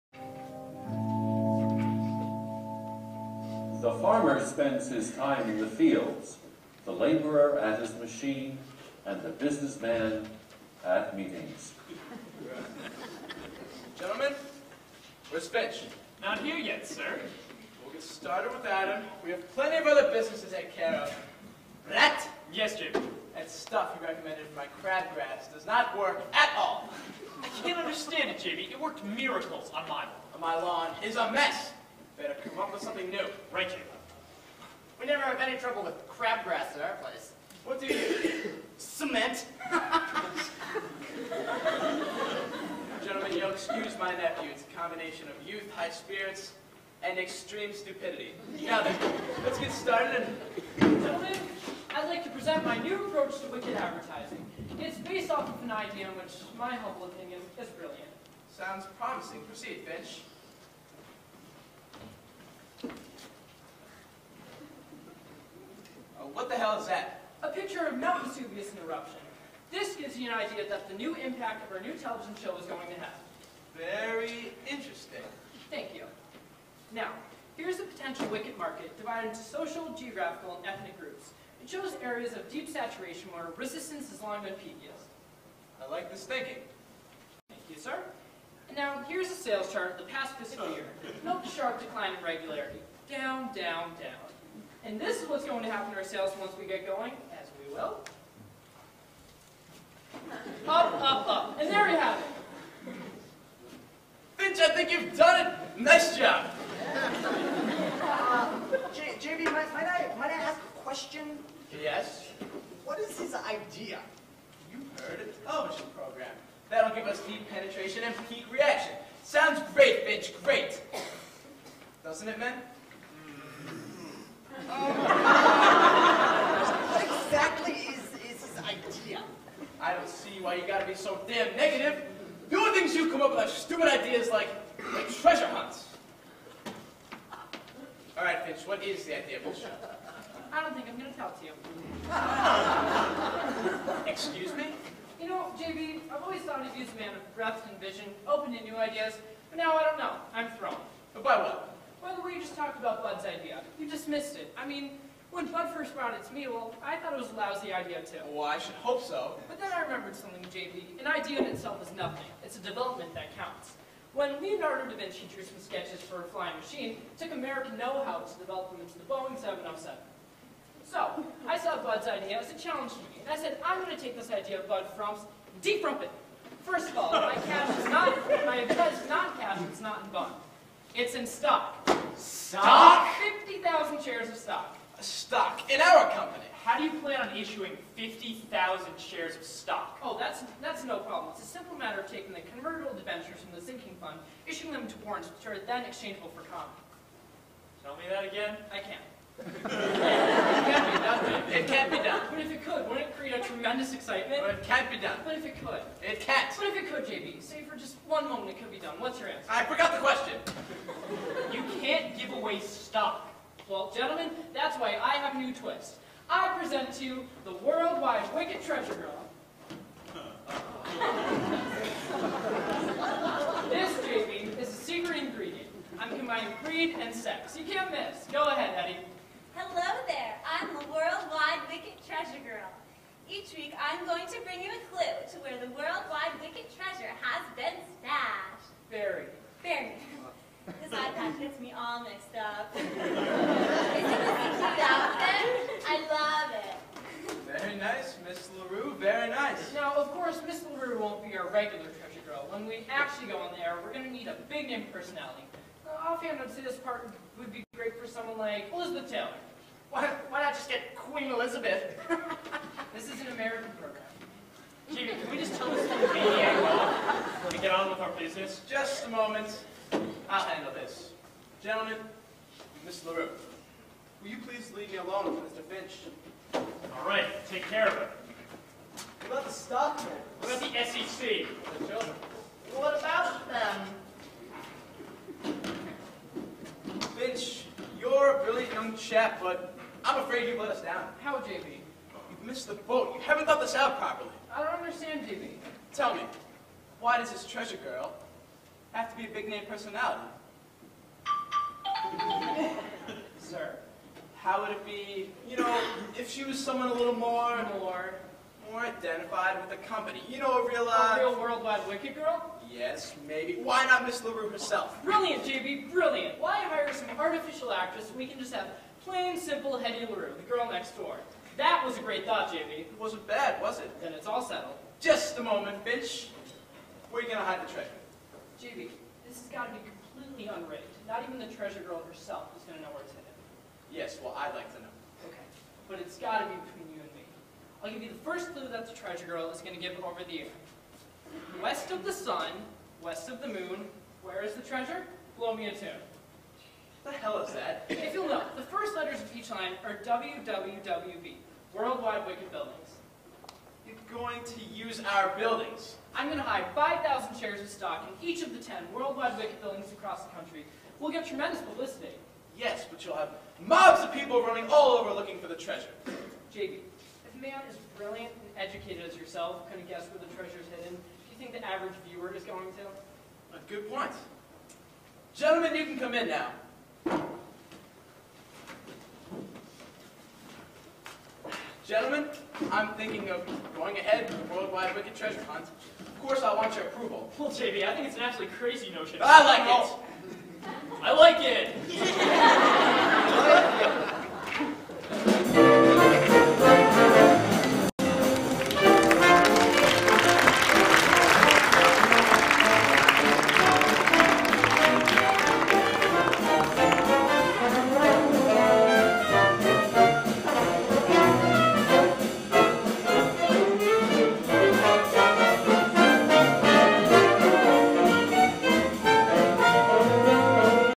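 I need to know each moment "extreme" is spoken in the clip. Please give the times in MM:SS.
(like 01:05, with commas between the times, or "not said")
00:47.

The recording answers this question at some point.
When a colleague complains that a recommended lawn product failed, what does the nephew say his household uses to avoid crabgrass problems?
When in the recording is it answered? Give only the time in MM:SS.
00:38.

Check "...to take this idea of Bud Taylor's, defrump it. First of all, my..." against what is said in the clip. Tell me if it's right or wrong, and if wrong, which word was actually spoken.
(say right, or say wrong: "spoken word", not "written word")
wrong: "Frump", not "Taylor".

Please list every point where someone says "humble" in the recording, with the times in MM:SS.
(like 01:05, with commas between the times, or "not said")
00:56.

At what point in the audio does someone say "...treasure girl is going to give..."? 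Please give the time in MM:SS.
05:38.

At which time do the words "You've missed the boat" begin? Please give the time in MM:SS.
04:52.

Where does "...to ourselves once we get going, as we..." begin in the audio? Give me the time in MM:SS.
01:35.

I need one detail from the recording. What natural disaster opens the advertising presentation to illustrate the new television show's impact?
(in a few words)
Mount Vesuvius in eruption.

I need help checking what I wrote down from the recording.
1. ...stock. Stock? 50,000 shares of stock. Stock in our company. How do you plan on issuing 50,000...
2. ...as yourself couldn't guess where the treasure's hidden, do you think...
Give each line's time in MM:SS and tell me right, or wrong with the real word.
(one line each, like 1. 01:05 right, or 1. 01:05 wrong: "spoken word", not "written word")
1. 03:01 right
2. 06:09 right.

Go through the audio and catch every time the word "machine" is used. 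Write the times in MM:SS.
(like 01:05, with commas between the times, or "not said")
00:07, 02:46.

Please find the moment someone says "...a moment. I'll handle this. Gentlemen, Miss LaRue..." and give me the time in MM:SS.
04:29.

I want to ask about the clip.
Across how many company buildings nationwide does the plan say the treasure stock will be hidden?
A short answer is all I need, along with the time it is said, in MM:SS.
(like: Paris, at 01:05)
10, at 05:58.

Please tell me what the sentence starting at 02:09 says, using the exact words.
I don't see why you gotta be so damn negative.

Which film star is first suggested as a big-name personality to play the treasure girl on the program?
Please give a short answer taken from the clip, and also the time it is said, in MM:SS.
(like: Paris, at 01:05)
Elizabeth Taylor, at 04:18.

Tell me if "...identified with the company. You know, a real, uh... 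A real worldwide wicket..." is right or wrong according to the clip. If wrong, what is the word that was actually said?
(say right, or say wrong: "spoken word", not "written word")
right.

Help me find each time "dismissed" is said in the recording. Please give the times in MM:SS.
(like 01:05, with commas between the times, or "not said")
02:33.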